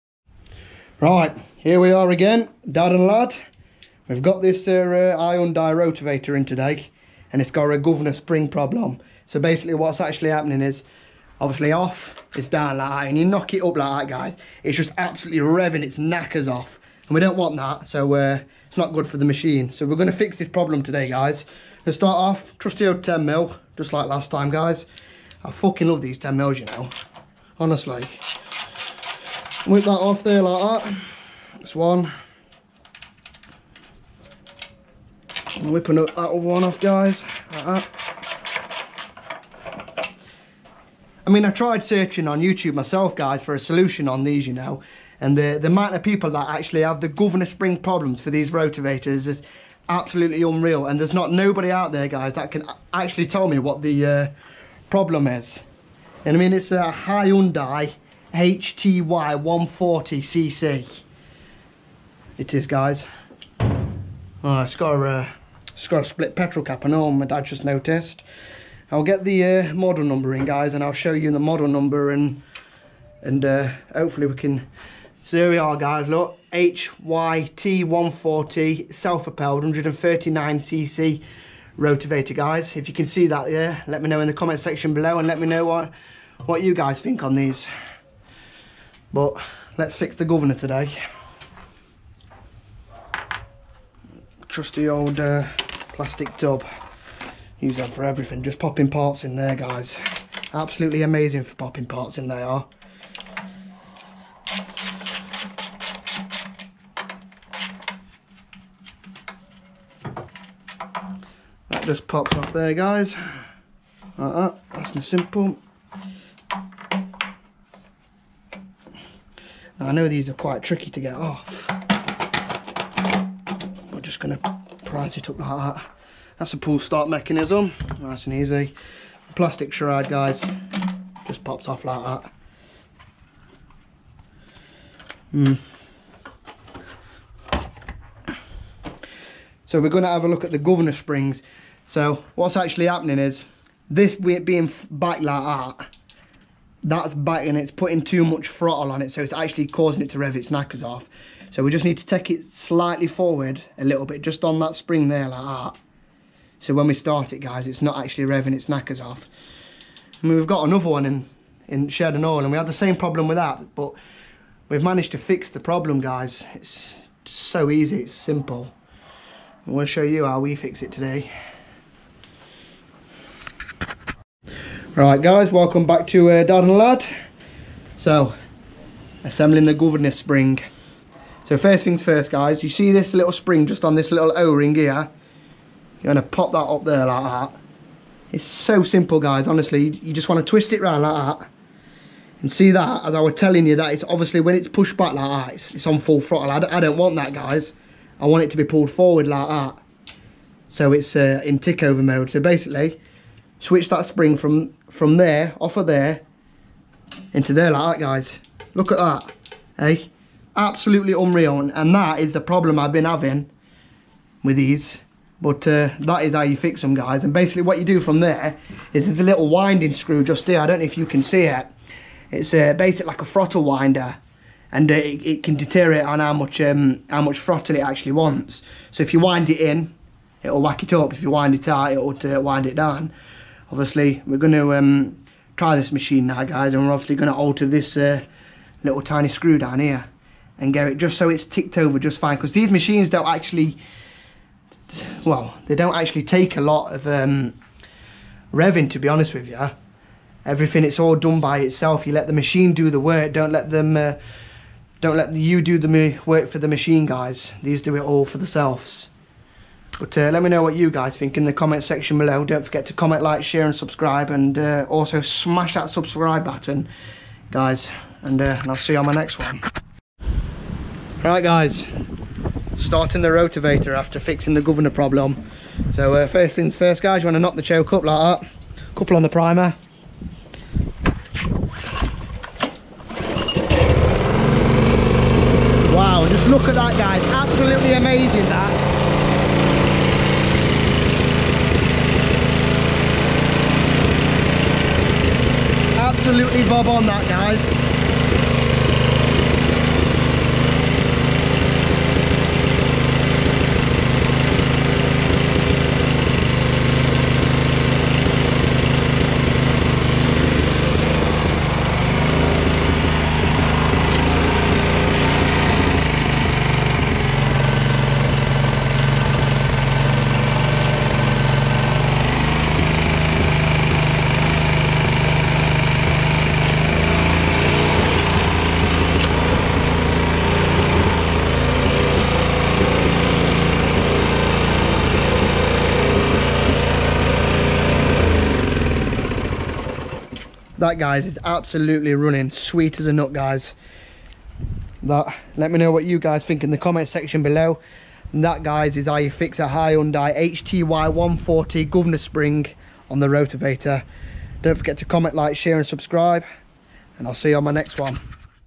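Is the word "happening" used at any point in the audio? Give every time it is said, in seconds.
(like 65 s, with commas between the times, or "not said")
10 s, 142 s.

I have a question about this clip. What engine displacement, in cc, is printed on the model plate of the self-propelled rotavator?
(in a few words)
139cc.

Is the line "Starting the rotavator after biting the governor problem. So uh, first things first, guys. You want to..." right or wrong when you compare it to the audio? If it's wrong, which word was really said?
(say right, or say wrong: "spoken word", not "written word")
wrong: "fixing", not "biting".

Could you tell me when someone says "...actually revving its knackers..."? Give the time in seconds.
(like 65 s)
158 s.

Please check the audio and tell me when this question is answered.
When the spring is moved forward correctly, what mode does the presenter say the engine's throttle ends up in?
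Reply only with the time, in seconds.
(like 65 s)
201 s.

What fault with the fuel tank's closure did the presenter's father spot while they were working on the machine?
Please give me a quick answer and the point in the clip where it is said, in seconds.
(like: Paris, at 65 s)
split petrol cap, at 66 s.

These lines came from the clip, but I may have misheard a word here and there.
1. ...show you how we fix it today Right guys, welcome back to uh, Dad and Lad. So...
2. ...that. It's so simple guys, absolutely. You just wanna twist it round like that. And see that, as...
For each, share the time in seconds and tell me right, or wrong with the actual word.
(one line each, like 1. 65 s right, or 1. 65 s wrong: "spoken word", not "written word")
1. 169 s right
2. 187 s wrong: "honestly", not "absolutely".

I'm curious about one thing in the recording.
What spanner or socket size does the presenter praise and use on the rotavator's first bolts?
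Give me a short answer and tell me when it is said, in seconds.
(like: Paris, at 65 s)
10 mil, at 23 s.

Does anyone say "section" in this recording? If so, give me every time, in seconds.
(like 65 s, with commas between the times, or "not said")
84 s, 261 s, 347 s.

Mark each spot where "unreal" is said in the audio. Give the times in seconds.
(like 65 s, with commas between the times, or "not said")
50 s, 211 s.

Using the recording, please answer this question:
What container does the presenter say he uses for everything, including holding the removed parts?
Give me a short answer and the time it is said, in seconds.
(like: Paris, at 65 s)
plastic tub, at 95 s.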